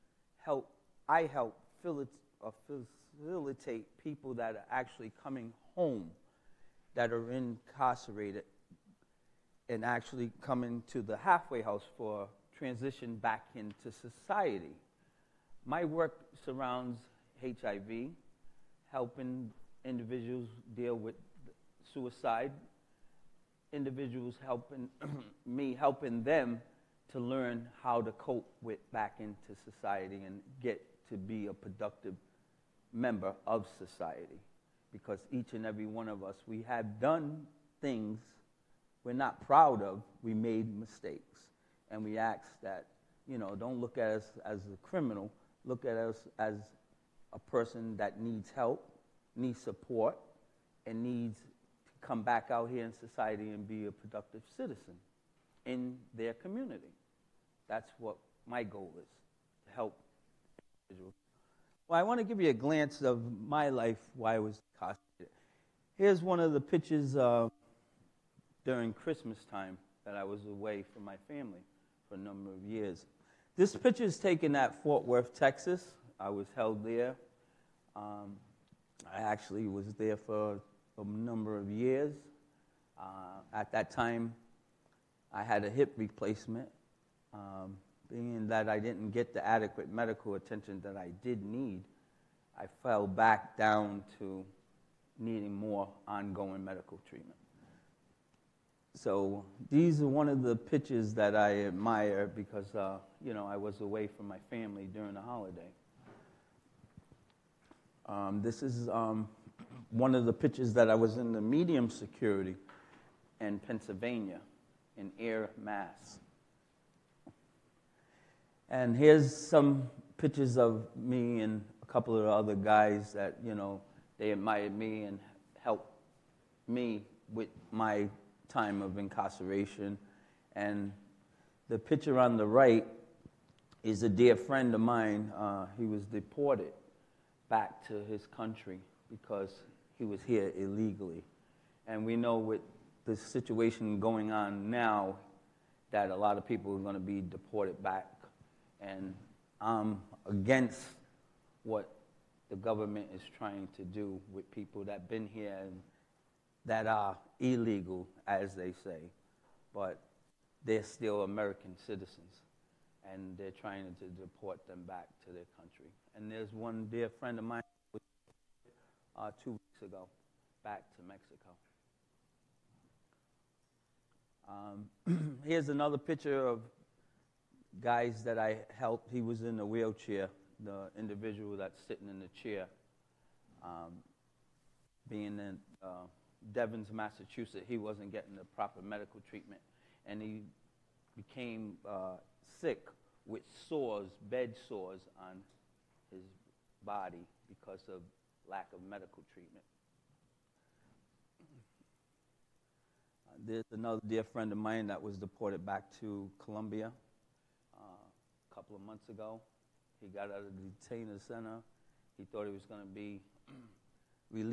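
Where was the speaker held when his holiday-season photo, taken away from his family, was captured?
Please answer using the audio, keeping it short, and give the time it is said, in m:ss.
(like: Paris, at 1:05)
Fort Worth, at 1:14.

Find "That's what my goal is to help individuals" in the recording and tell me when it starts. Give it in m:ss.
0:57.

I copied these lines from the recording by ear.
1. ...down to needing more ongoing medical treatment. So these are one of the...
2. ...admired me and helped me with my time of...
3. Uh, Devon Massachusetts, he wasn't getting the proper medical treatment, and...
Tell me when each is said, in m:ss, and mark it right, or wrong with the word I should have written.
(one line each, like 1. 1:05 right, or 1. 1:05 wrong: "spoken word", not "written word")
1. 1:33 right
2. 2:04 right
3. 3:05 right.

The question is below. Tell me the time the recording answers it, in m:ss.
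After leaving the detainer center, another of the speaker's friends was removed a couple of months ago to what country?
3:26.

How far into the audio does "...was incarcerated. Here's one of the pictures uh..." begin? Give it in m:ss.
1:04.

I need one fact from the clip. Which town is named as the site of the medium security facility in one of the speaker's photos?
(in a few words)
Ayer.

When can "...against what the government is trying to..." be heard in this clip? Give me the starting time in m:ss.
2:30.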